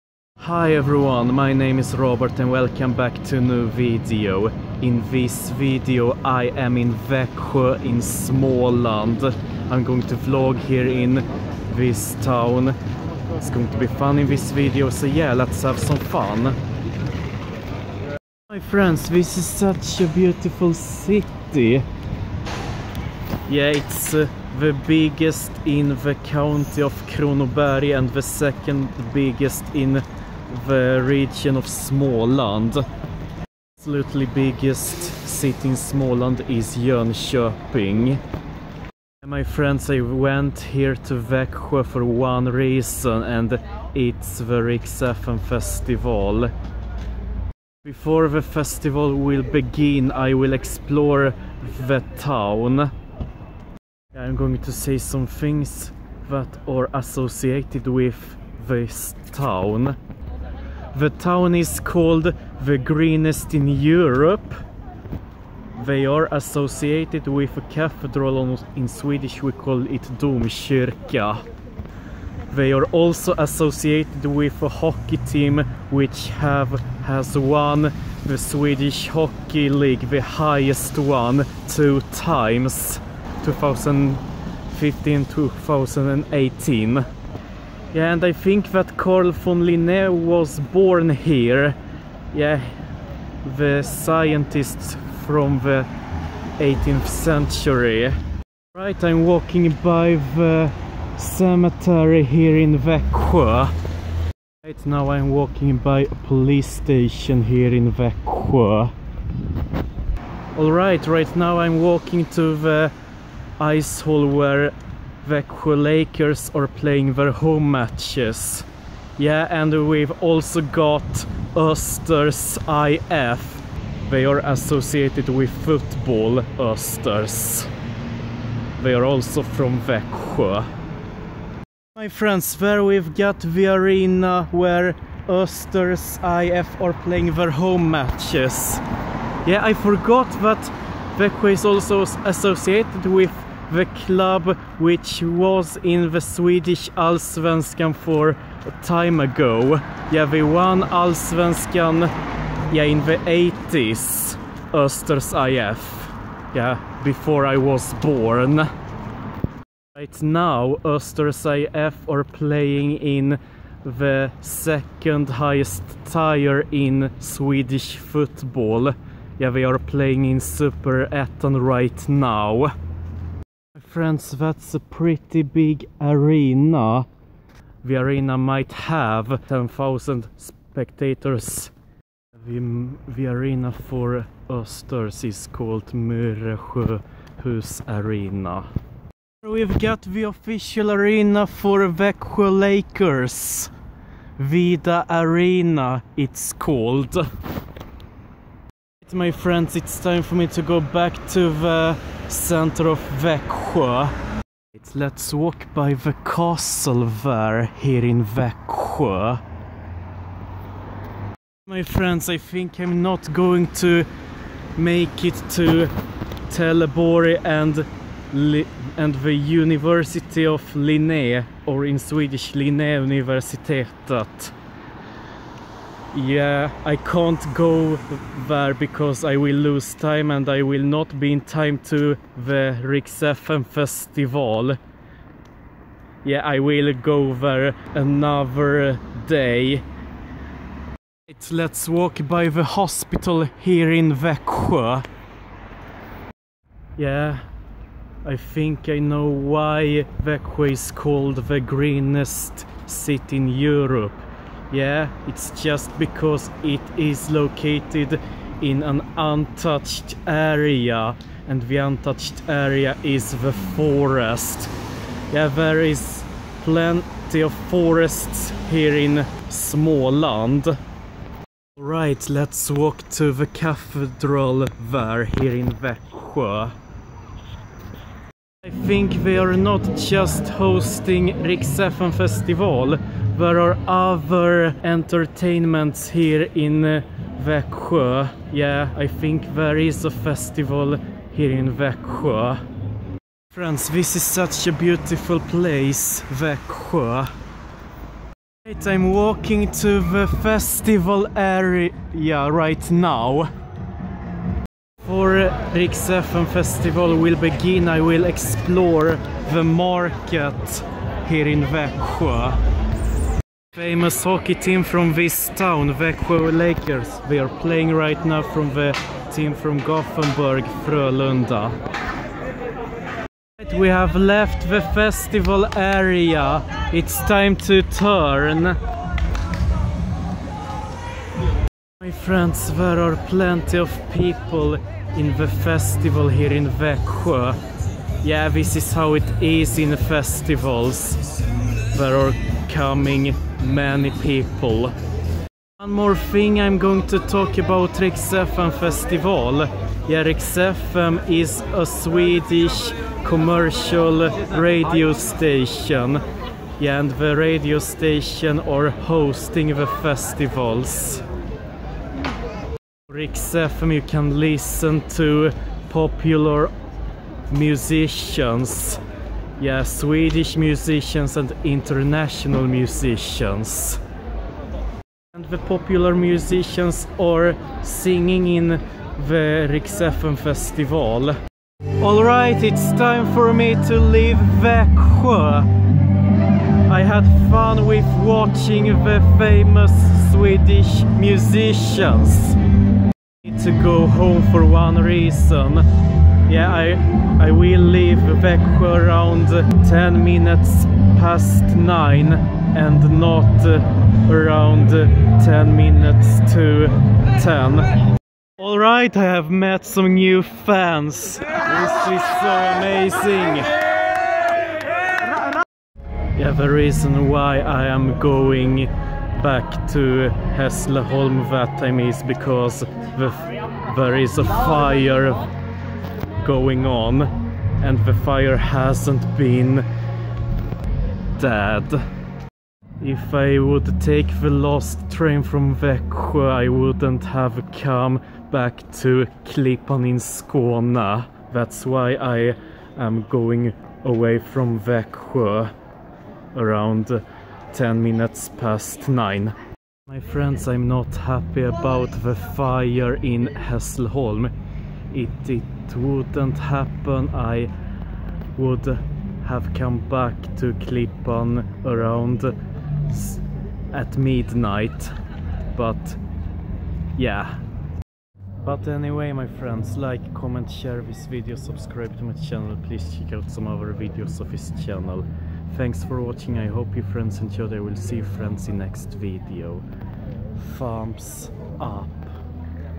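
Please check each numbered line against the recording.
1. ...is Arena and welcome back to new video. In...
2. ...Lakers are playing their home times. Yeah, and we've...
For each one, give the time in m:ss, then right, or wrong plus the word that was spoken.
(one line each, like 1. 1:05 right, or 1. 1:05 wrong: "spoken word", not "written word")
1. 0:01 wrong: "Robert", not "Arena"
2. 1:55 wrong: "matches", not "times".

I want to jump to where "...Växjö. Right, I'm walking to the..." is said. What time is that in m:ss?
4:56.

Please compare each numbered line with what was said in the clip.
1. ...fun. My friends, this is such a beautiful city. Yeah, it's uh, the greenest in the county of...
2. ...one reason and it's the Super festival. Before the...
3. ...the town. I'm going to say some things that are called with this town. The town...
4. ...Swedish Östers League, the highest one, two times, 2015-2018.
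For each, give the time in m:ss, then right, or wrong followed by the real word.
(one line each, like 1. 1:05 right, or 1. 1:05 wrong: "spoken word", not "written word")
1. 0:15 wrong: "biggest", not "greenest"
2. 0:42 wrong: "Rix", not "Super"
3. 0:51 wrong: "associated", not "called"
4. 1:18 wrong: "Hockey", not "Östers".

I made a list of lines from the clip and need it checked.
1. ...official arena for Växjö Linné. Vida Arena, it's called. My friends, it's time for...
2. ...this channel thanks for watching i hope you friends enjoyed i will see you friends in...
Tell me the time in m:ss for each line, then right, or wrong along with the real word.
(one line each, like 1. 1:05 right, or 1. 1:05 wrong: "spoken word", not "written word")
1. 3:10 wrong: "Lakers", not "Linné"
2. 7:54 right.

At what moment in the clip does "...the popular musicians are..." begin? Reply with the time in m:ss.
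6:15.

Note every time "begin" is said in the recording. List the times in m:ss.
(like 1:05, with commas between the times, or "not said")
0:49, 5:07.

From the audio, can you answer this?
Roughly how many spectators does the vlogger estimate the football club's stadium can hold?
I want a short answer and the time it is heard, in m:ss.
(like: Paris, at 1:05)
10,000, at 2:59.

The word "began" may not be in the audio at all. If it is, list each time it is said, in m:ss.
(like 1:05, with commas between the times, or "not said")
not said.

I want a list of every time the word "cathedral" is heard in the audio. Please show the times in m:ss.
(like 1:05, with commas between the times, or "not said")
1:07, 4:33.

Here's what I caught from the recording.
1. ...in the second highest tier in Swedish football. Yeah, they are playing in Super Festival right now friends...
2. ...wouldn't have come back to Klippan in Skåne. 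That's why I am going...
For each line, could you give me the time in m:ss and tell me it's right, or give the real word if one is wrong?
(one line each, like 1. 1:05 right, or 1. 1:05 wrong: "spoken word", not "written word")
1. 2:42 wrong: "Eton", not "Festival"
2. 7:16 right.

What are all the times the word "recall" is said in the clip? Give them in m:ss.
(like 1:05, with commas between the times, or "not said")
not said.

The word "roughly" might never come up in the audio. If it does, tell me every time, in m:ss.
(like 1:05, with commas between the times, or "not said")
not said.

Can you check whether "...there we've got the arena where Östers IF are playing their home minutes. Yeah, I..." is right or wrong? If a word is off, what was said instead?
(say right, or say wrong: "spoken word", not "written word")
wrong: "matches", not "minutes".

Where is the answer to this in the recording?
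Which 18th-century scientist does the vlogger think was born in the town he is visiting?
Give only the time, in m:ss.
1:28.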